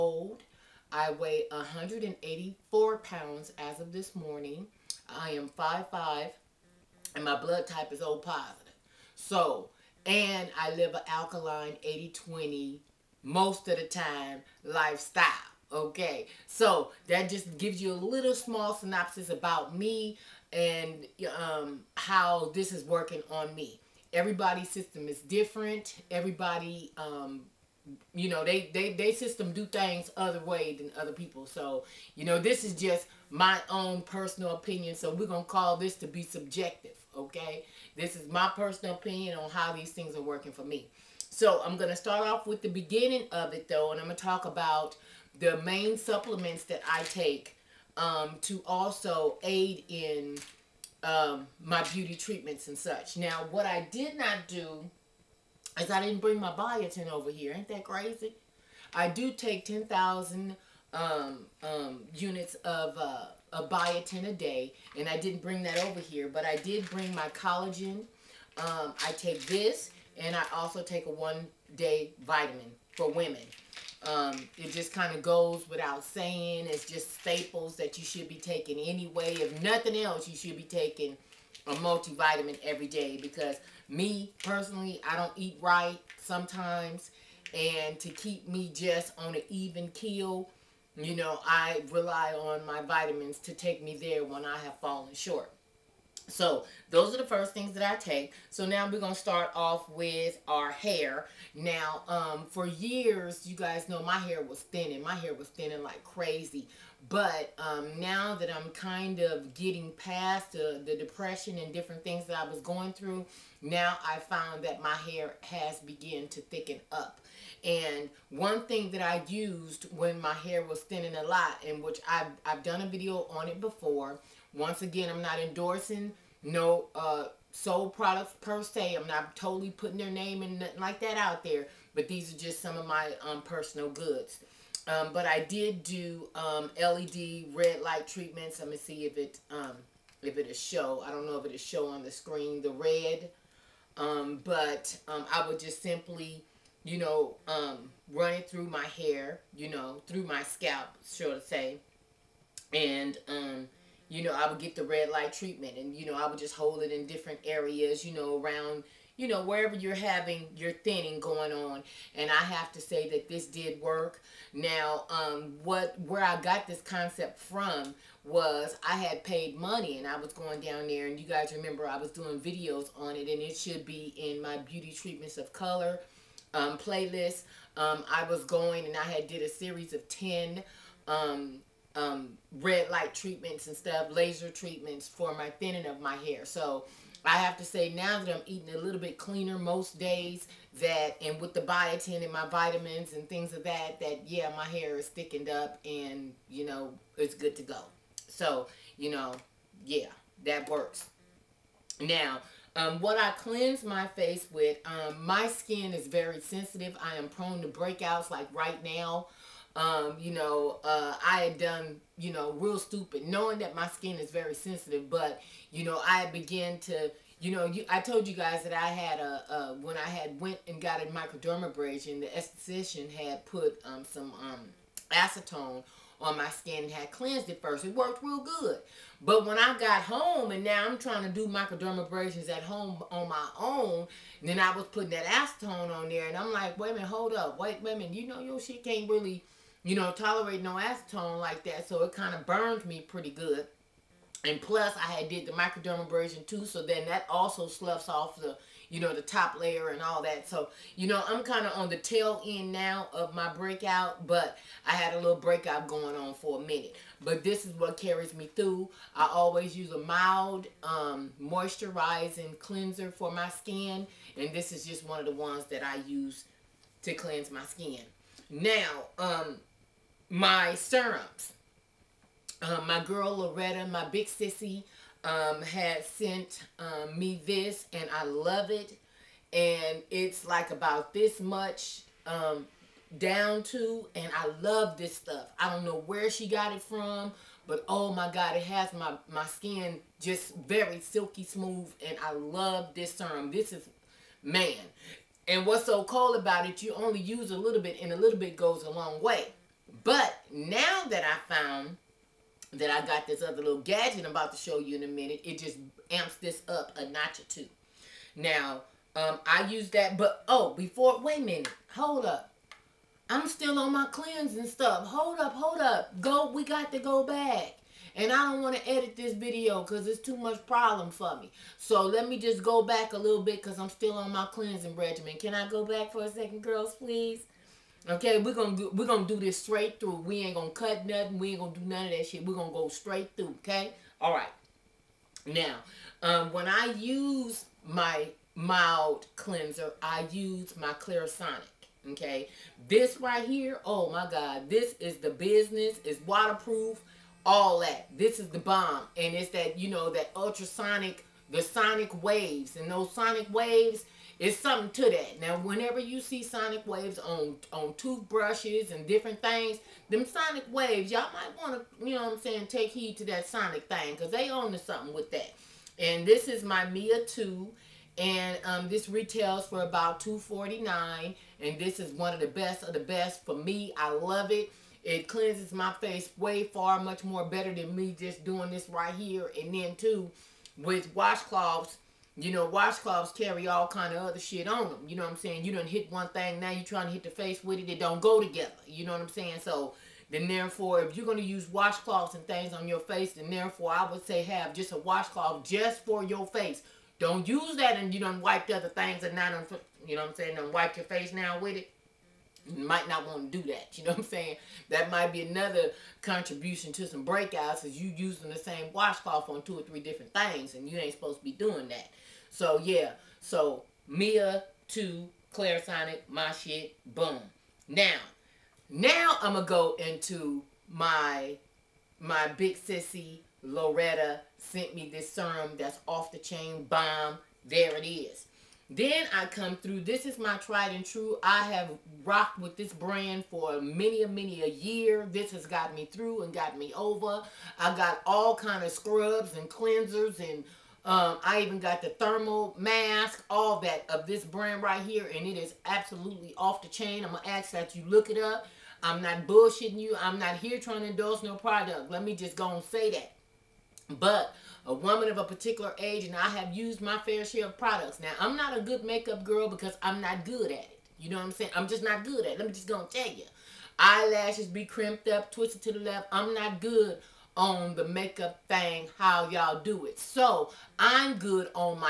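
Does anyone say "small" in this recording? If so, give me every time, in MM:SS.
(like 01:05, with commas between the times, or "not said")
00:18.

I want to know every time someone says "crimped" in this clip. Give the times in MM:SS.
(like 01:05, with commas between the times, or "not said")
07:44.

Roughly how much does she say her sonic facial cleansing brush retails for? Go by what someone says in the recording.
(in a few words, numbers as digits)
$249.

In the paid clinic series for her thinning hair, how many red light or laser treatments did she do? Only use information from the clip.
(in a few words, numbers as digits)
10.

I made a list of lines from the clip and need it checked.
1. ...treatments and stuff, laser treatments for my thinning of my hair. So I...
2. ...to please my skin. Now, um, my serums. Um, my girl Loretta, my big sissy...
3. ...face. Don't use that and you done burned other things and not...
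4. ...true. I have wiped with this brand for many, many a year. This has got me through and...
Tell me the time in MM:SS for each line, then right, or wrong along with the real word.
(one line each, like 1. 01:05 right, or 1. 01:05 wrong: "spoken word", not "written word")
1. 03:03 right
2. 04:27 wrong: "cleanse", not "please"
3. 06:36 wrong: "wiped", not "burned"
4. 07:11 wrong: "rocked", not "wiped".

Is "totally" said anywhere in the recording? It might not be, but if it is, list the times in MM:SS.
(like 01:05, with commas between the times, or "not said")
02:09.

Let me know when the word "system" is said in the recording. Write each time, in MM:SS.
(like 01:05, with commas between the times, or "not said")
00:24, 00:29.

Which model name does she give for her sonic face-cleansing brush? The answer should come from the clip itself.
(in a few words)
Mia 2.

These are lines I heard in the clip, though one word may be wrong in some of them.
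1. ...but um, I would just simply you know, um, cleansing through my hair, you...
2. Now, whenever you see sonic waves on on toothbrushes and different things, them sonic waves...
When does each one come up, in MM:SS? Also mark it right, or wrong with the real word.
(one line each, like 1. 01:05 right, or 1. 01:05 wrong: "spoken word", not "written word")
1. 02:24 wrong: "running", not "cleansing"
2. 05:55 right.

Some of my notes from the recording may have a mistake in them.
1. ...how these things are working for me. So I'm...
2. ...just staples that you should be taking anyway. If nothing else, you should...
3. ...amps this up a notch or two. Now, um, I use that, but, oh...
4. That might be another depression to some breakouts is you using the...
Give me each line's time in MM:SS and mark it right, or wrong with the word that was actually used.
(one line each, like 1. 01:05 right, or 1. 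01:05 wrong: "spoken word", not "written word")
1. 00:39 right
2. 01:16 right
3. 05:06 right
4. 06:44 wrong: "contribution", not "depression".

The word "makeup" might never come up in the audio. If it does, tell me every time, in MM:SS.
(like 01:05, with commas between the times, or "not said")
07:39, 07:48.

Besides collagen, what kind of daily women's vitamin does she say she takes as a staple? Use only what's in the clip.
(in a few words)
one-day vitamin.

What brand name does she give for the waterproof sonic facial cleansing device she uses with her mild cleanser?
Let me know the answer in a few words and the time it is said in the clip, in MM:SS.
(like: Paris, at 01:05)
Clarisonic, at 05:40.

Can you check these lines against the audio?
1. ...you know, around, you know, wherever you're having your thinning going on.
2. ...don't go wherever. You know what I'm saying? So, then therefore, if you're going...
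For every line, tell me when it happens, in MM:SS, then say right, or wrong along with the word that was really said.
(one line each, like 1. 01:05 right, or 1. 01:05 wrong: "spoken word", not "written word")
1. 02:38 right
2. 06:27 wrong: "together", not "wherever".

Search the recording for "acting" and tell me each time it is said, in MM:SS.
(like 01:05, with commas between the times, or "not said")
not said.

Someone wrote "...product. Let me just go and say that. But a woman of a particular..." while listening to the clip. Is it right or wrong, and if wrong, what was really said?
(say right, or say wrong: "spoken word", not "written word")
right.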